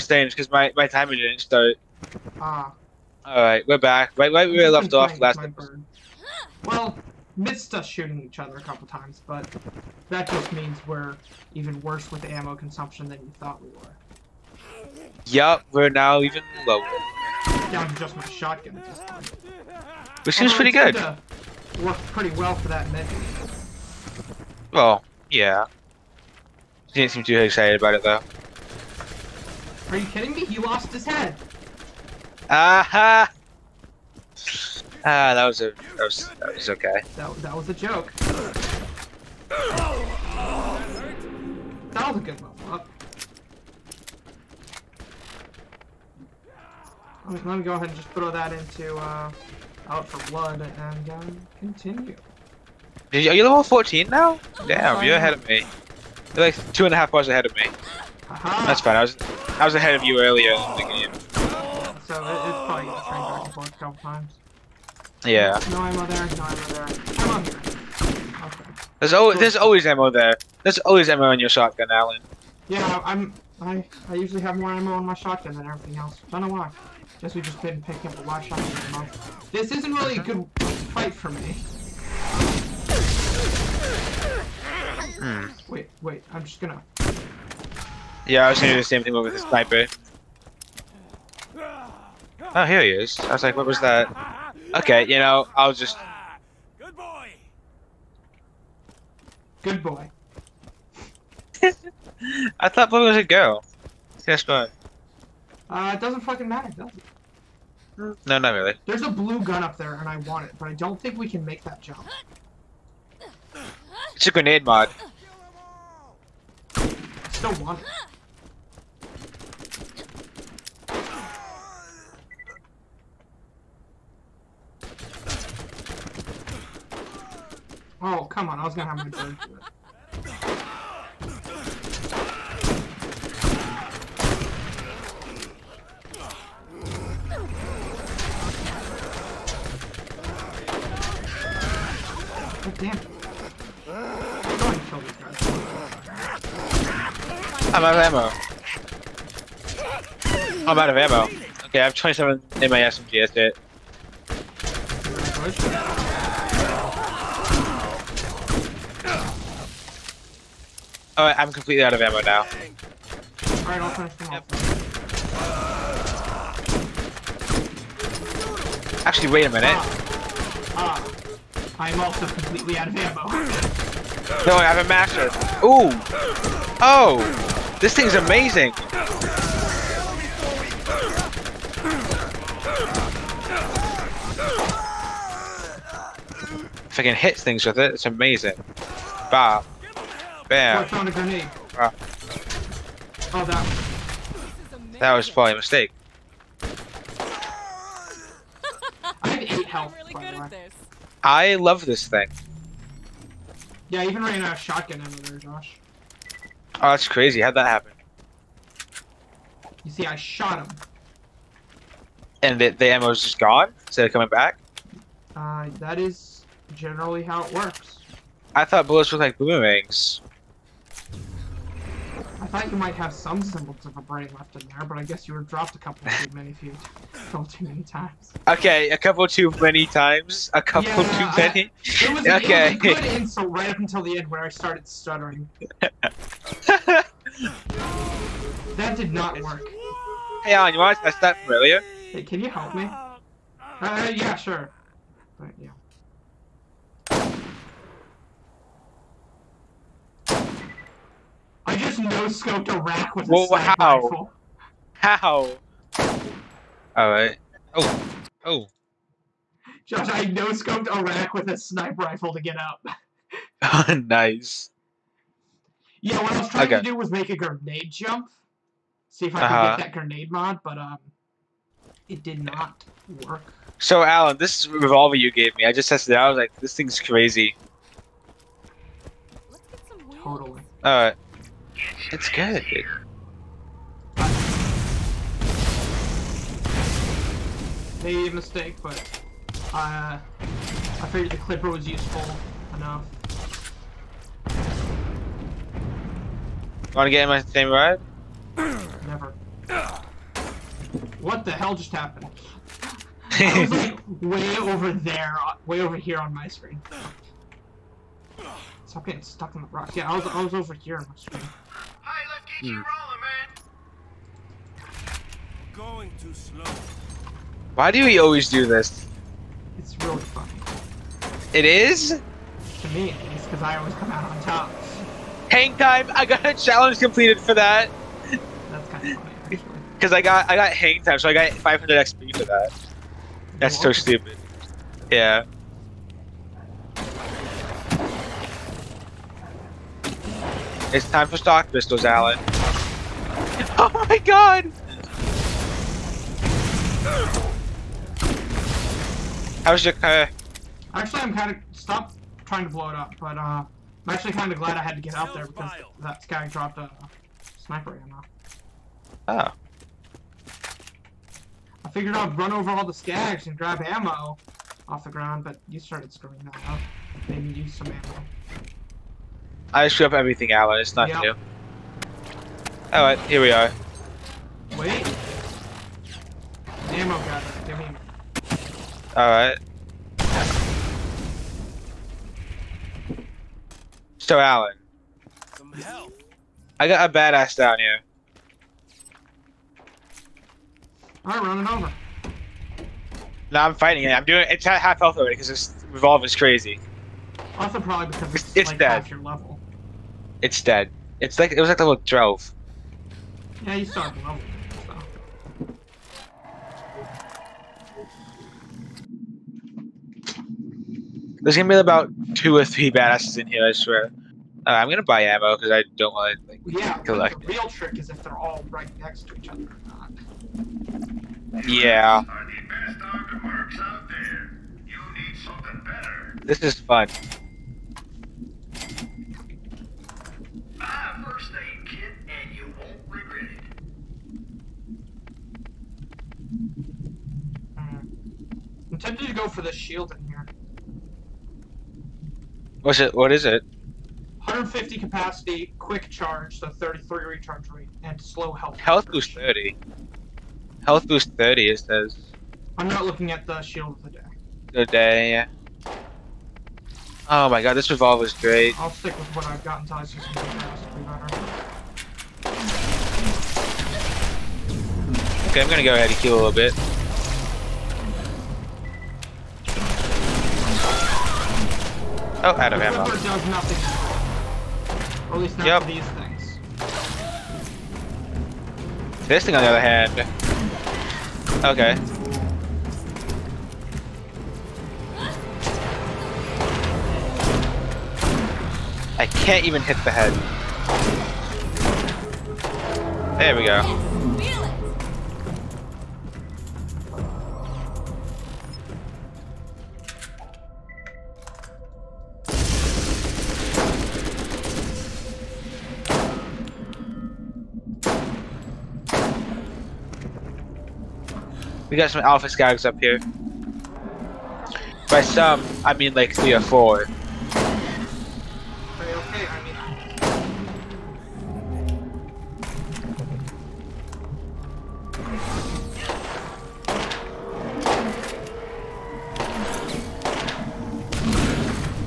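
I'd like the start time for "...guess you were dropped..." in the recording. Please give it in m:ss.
3:45.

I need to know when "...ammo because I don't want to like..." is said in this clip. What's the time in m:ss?
6:55.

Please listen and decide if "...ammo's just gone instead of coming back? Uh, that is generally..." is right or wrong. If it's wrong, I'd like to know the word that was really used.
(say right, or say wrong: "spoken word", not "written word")
right.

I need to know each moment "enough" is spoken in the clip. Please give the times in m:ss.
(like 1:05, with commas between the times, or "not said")
4:52.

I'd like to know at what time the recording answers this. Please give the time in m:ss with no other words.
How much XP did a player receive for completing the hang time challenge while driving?
5:31.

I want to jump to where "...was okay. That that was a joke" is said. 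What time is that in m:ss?
0:36.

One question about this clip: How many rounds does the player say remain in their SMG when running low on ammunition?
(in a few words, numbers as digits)
27.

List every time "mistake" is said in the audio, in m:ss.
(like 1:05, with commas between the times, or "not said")
3:15, 4:48.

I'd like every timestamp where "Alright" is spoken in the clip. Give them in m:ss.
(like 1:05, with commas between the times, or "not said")
2:43, 4:16, 4:40, 6:12, 6:19, 6:31.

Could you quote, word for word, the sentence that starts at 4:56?
Wanna get in my same ride?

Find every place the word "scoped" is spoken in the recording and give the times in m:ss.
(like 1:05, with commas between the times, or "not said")
4:12, 4:20.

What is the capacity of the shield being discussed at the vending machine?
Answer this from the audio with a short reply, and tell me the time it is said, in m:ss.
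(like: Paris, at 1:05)
150, at 7:24.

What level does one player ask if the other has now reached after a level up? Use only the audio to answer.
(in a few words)
14.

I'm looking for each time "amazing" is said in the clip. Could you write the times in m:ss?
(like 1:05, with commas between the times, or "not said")
2:58, 3:08.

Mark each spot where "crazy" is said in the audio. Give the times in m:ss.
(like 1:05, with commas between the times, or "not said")
3:27, 4:36, 6:36.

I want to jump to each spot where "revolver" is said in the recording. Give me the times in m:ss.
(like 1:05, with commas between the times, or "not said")
4:34, 6:35, 7:37.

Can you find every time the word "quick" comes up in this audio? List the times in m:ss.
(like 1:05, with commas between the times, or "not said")
7:25.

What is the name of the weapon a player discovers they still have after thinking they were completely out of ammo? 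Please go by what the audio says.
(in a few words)
Masher.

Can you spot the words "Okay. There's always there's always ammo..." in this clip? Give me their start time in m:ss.
1:08.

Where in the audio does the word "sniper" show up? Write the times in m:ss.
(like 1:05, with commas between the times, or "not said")
1:29, 4:13, 4:21, 5:57.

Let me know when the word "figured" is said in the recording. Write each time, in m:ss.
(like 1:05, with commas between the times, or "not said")
4:51, 6:01.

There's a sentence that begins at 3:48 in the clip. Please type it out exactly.
Okay, a couple too many times, a couple yeah, too I, many.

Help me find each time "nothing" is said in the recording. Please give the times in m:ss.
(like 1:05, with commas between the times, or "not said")
6:10, 7:53.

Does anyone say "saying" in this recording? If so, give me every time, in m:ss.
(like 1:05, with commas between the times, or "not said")
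0:00.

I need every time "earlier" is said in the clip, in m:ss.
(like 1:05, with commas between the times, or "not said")
1:00, 4:01.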